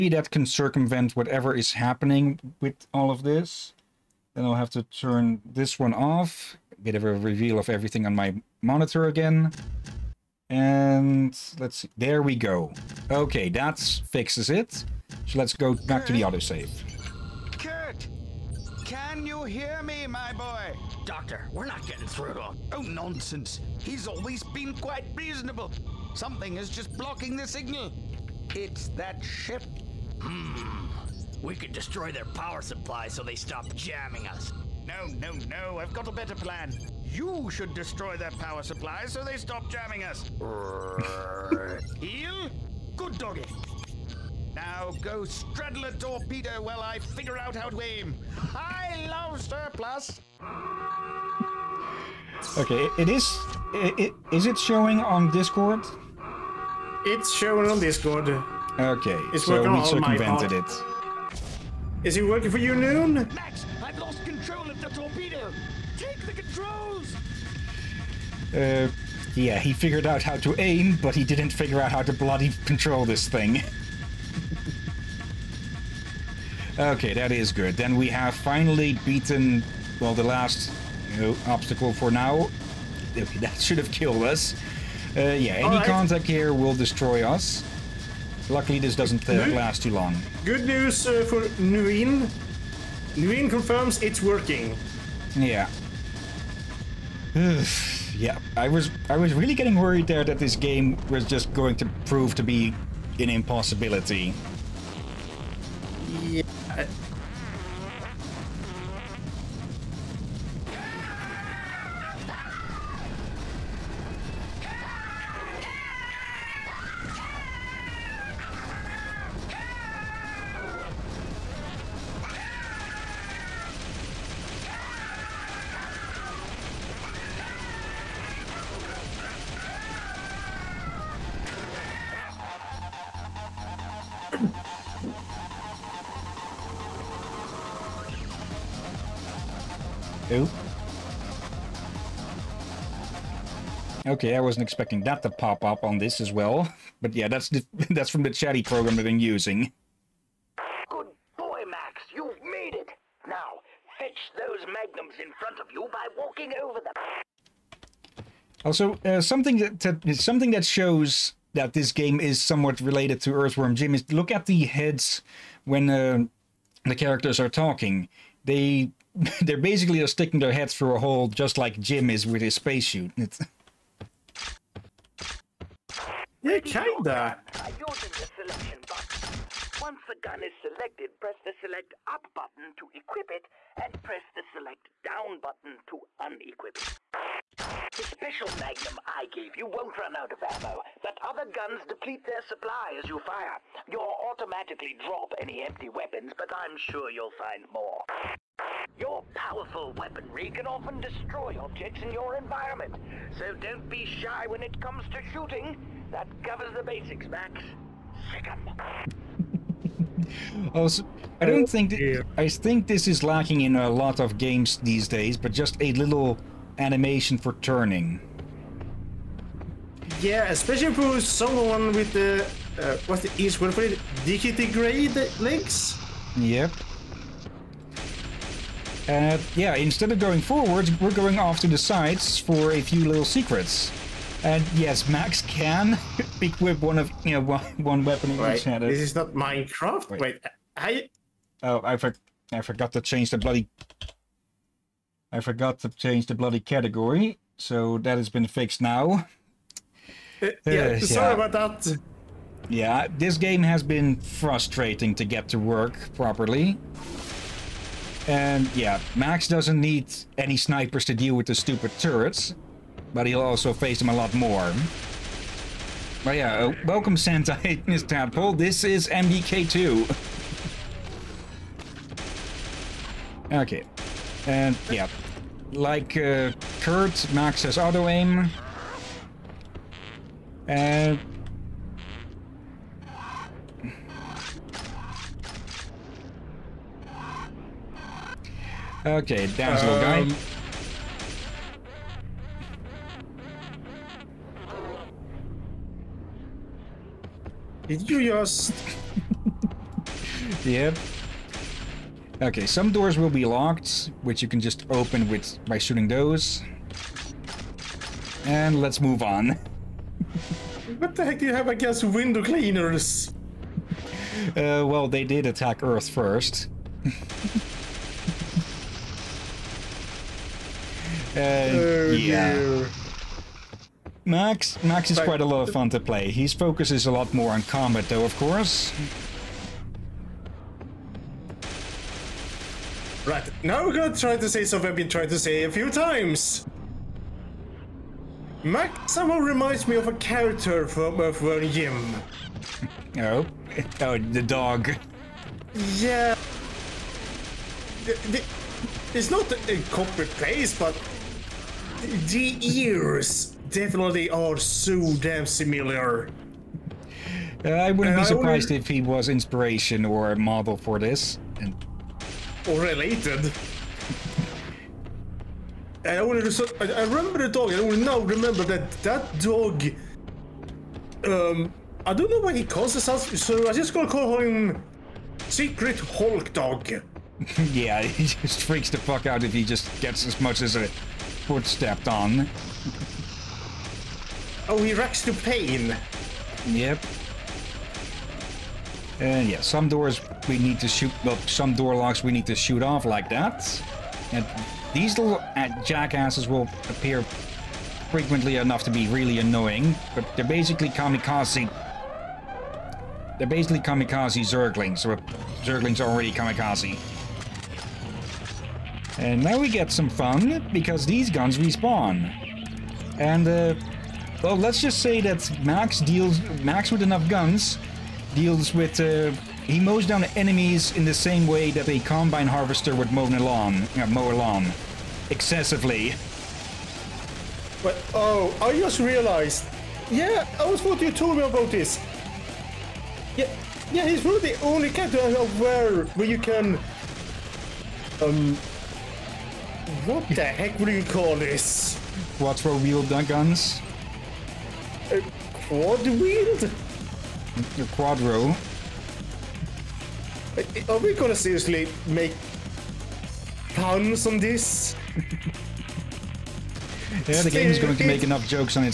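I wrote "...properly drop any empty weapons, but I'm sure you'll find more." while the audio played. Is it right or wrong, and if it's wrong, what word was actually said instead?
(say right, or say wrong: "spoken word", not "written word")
wrong: "automatically", not "properly".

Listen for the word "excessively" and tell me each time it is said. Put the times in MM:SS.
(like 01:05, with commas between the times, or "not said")
07:05.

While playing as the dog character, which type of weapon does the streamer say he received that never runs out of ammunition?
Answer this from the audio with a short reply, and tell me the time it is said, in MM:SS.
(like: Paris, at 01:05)
Magnum, at 03:08.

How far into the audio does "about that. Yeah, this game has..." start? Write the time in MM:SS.
04:11.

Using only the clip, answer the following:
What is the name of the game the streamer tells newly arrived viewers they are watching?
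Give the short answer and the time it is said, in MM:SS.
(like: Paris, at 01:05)
MDK2, at 04:29.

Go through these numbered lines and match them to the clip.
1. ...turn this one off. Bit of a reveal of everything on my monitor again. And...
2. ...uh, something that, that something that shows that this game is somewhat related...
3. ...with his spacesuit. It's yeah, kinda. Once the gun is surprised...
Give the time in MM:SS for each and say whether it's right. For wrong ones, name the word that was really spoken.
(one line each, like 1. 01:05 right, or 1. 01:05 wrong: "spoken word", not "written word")
1. 00:04 right
2. 02:39 right
3. 02:52 wrong: "selected", not "surprised".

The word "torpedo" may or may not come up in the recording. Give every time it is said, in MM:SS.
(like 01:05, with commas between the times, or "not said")
00:45, 01:04.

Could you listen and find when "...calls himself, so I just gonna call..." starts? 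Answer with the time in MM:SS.
06:12.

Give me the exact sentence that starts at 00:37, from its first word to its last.
You should destroy their power supply so they stop jamming us.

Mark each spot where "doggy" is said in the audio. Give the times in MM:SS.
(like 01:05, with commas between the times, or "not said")
00:43.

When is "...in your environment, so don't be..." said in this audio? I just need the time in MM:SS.
03:22.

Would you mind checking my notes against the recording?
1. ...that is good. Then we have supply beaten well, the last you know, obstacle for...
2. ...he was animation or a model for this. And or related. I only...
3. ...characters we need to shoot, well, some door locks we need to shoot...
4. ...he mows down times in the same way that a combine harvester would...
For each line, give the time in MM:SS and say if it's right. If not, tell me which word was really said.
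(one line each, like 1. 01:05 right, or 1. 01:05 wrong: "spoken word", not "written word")
1. 01:17 wrong: "finally", not "supply"
2. 05:58 wrong: "inspiration", not "animation"
3. 06:29 wrong: "doors", not "characters"
4. 06:59 wrong: "enemies", not "times".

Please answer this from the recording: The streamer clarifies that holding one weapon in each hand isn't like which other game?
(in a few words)
Minecraft.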